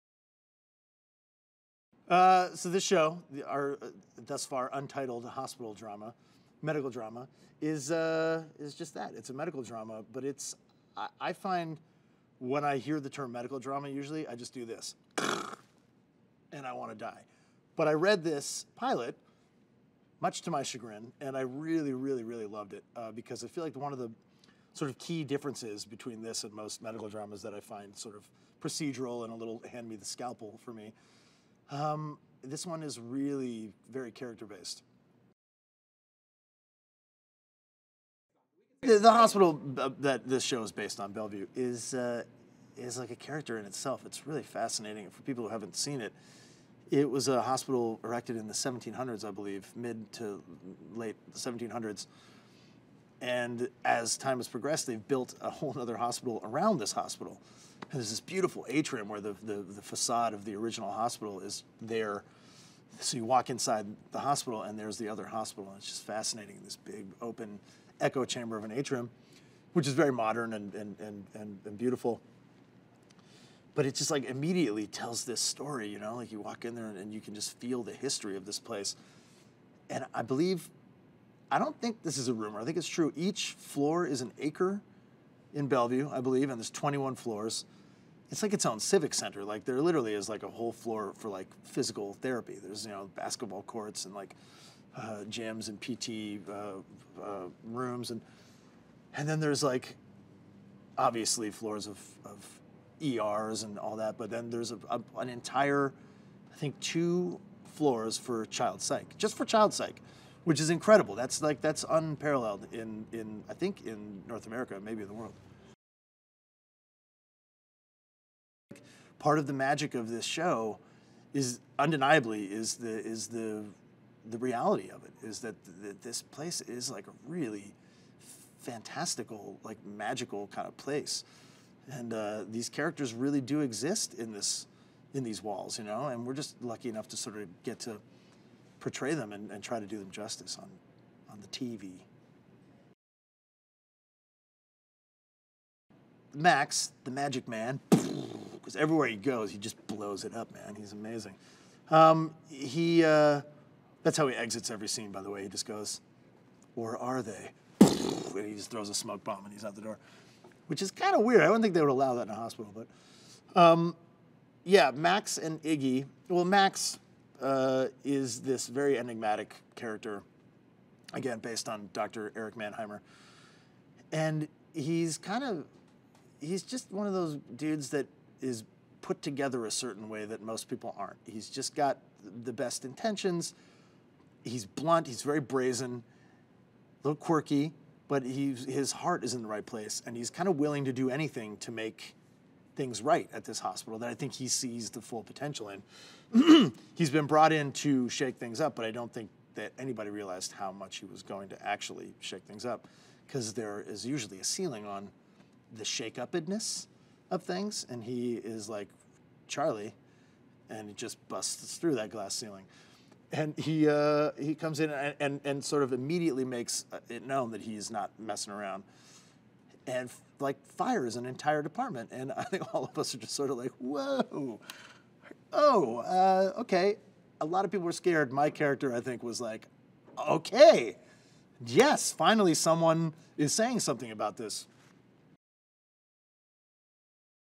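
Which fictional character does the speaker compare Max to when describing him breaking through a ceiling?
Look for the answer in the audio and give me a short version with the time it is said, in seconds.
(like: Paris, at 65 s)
Charlie, at 209 s.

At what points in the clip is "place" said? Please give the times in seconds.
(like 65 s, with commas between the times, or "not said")
78 s, 126 s, 130 s, 189 s.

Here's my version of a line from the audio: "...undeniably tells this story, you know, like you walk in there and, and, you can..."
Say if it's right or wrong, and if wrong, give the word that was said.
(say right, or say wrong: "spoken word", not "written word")
wrong: "immediately", not "undeniably".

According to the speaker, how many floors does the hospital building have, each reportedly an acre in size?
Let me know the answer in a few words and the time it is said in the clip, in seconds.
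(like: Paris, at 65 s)
21, at 86 s.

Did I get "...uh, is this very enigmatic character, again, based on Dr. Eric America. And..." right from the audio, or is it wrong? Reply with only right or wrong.
wrong.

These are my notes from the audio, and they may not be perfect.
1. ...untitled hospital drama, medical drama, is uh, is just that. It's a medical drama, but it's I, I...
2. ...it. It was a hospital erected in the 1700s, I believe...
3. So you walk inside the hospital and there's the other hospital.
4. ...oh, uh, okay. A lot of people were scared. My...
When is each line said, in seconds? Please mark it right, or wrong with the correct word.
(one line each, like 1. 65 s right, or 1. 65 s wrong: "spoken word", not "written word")
1. 4 s right
2. 46 s right
3. 62 s right
4. 225 s right.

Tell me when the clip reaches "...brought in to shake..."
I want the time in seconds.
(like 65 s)
197 s.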